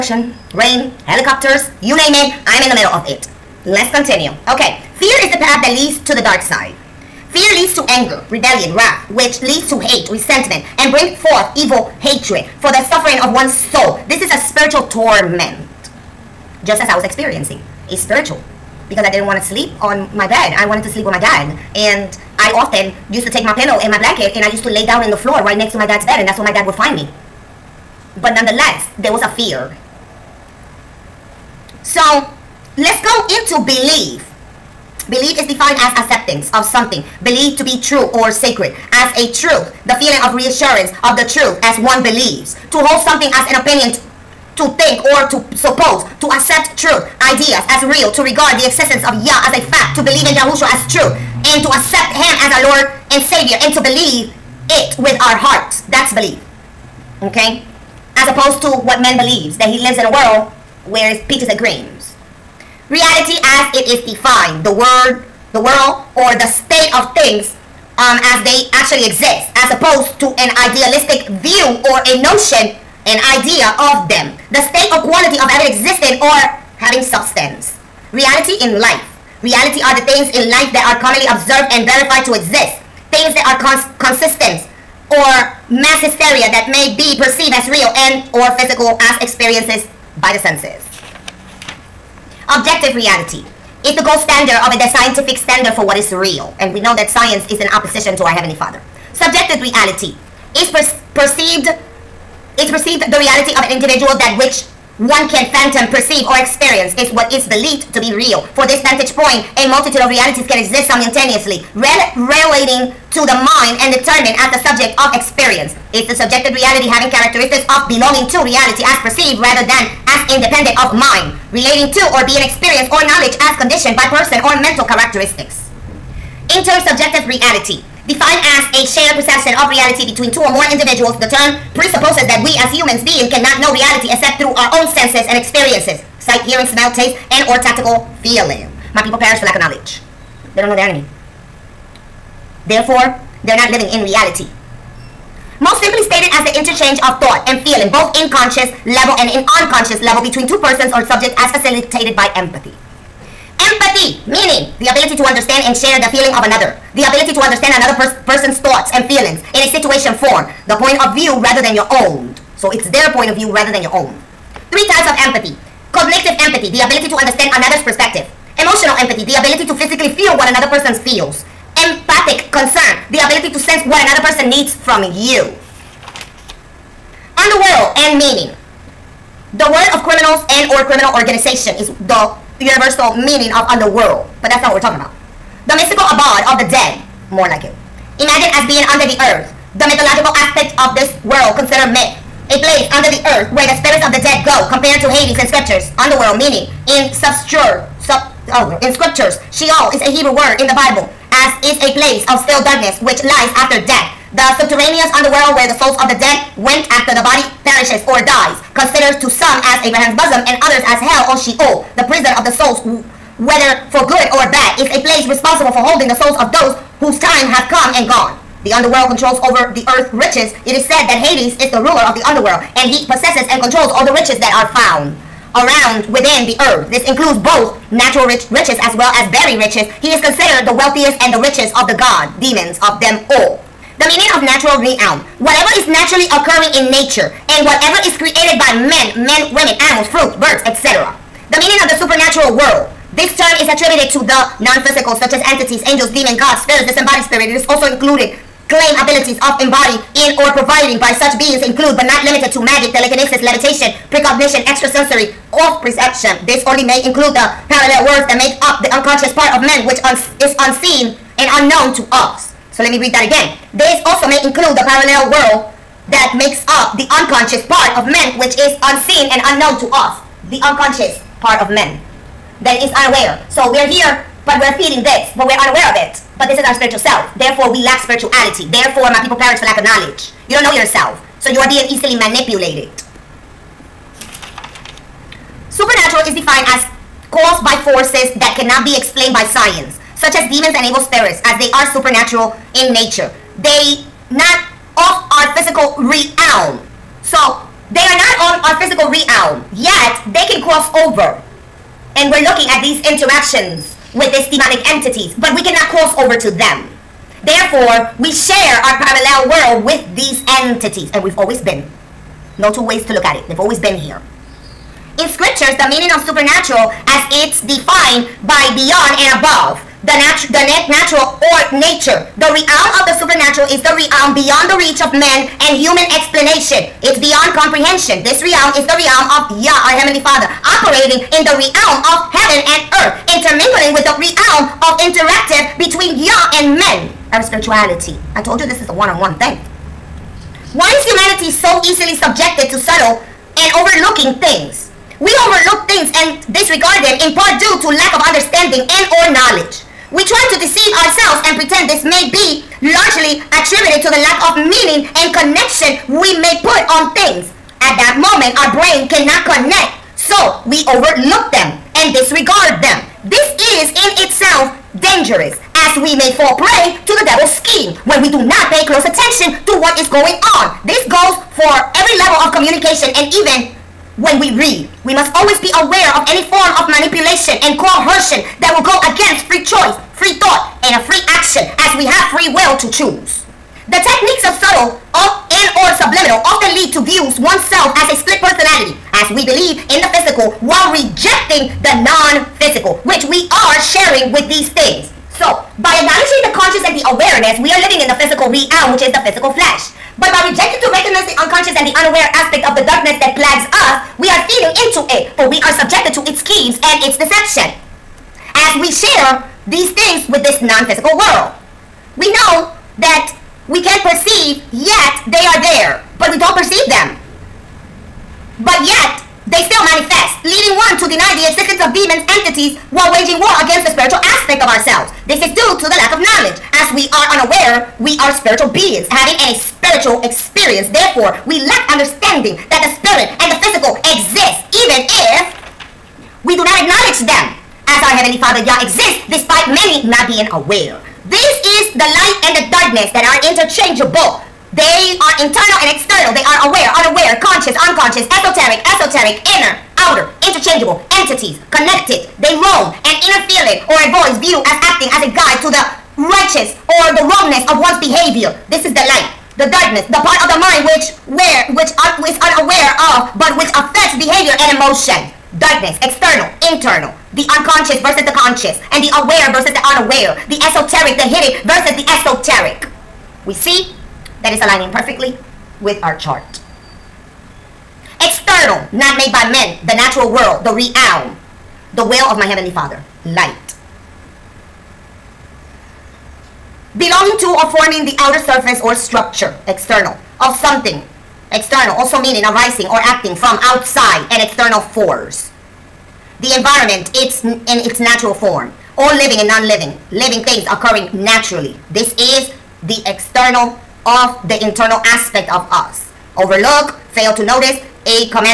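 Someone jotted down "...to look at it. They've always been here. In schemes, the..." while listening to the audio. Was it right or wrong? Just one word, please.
wrong.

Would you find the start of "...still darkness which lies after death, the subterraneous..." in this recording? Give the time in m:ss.
3:22.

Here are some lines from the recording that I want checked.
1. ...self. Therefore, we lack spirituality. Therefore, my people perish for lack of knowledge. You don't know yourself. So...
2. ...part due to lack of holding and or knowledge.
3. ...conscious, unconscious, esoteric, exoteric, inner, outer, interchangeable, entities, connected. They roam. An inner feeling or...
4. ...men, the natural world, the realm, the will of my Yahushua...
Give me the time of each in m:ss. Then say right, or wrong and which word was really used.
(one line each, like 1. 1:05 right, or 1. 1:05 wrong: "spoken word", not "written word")
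1. 4:36 right
2. 5:47 wrong: "understanding", not "holding"
3. 7:27 right
4. 7:59 wrong: "Heavenly", not "Yahushua".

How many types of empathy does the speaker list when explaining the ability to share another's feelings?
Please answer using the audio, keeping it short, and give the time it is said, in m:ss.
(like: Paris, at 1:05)
3, at 2:44.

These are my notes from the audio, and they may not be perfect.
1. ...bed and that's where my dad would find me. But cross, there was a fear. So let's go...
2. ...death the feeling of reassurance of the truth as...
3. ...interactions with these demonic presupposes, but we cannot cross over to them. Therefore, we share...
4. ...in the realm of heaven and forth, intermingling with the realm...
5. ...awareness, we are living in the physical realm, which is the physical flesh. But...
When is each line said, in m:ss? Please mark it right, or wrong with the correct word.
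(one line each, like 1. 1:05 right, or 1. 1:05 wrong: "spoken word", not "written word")
1. 0:26 wrong: "nonetheless", not "cross"
2. 0:39 wrong: "truth", not "death"
3. 5:03 wrong: "entities", not "presupposes"
4. 5:31 wrong: "earth", not "forth"
5. 6:37 right.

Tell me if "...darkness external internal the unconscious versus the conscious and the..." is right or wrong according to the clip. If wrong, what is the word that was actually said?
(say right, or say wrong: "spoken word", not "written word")
right.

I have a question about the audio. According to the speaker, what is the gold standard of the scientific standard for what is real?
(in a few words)
Objective reality.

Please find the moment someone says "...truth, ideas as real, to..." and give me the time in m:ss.
0:46.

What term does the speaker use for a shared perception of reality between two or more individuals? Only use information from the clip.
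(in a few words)
Intersubjective reality.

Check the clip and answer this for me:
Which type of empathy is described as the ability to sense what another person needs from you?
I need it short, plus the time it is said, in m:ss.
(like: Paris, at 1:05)
Empathic concern, at 2:51.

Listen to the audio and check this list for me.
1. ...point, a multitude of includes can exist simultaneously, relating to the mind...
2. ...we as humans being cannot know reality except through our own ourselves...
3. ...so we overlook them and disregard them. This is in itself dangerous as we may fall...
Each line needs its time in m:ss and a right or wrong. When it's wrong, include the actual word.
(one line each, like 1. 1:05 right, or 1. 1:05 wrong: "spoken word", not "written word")
1. 1:49 wrong: "realities", not "includes"
2. 2:12 wrong: "senses", not "ourselves"
3. 6:00 right.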